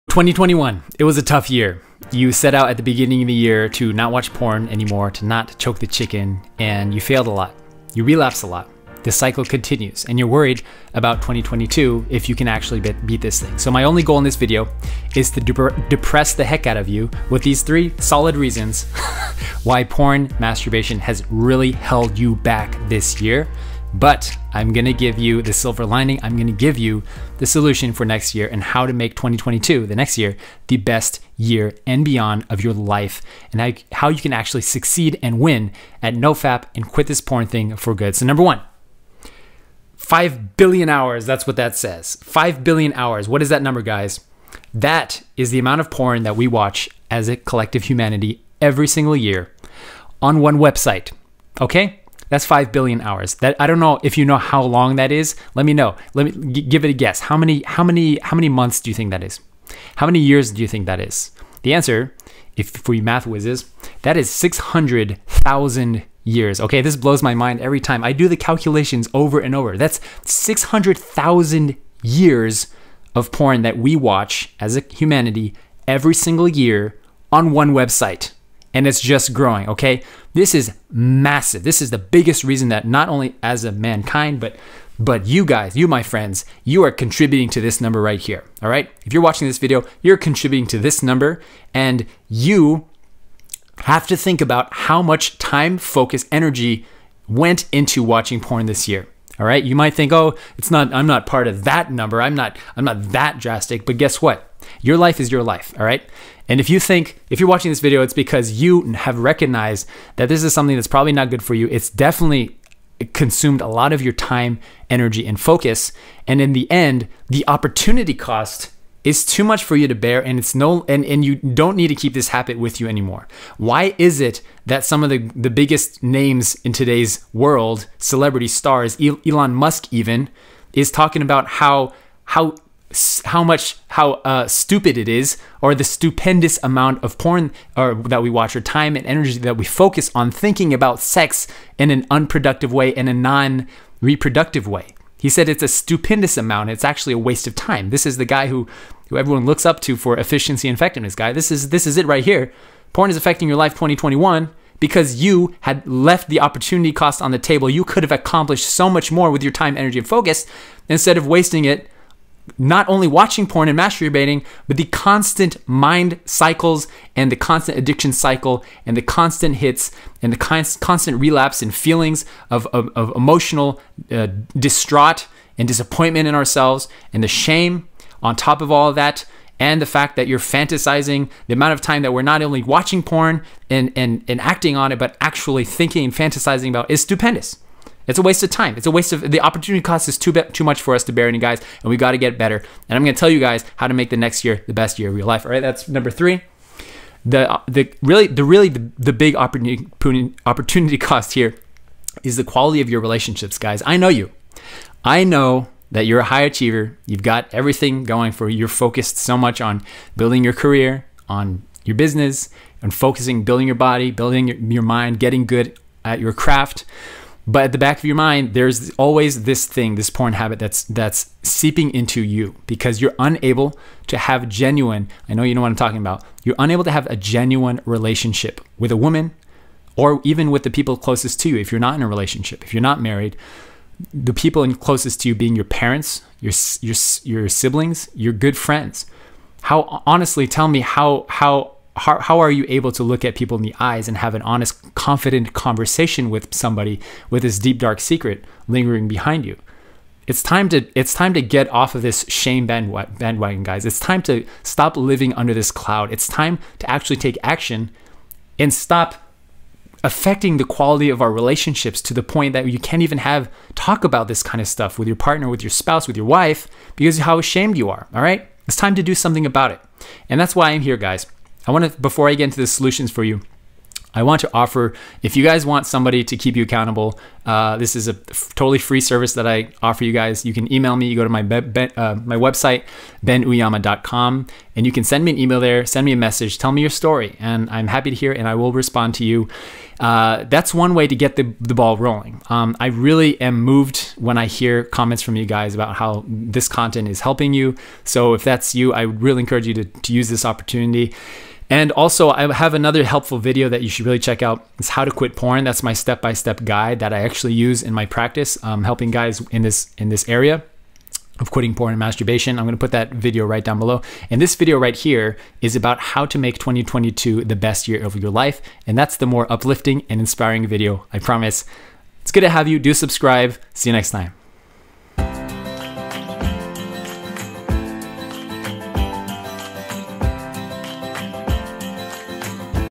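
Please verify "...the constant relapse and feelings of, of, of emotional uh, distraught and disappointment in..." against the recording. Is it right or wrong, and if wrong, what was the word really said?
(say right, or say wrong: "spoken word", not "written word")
right.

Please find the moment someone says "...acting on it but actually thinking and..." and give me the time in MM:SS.
03:04.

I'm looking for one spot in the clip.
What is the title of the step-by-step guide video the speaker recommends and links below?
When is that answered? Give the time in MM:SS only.
05:04.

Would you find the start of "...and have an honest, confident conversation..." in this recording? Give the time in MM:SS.
04:04.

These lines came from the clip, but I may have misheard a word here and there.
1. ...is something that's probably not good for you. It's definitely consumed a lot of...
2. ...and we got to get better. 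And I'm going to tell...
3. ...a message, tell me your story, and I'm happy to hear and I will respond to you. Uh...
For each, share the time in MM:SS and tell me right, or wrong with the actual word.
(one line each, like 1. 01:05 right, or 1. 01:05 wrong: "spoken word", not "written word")
1. 01:50 right
2. 03:11 right
3. 04:46 right.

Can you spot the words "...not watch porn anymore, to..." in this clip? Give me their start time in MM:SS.
00:03.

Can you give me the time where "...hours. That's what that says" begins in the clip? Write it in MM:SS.
00:40.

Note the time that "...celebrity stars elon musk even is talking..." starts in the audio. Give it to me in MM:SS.
02:07.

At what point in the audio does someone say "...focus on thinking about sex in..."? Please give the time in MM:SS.
02:19.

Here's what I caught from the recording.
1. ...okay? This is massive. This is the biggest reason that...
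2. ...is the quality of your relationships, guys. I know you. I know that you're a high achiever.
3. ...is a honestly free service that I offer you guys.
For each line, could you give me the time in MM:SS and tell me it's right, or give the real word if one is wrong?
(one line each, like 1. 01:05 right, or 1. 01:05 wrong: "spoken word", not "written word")
1. 01:19 right
2. 03:22 right
3. 04:37 wrong: "totally", not "honestly".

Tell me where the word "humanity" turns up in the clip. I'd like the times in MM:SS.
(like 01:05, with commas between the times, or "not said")
00:47, 01:14.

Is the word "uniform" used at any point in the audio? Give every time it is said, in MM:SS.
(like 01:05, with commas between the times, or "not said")
not said.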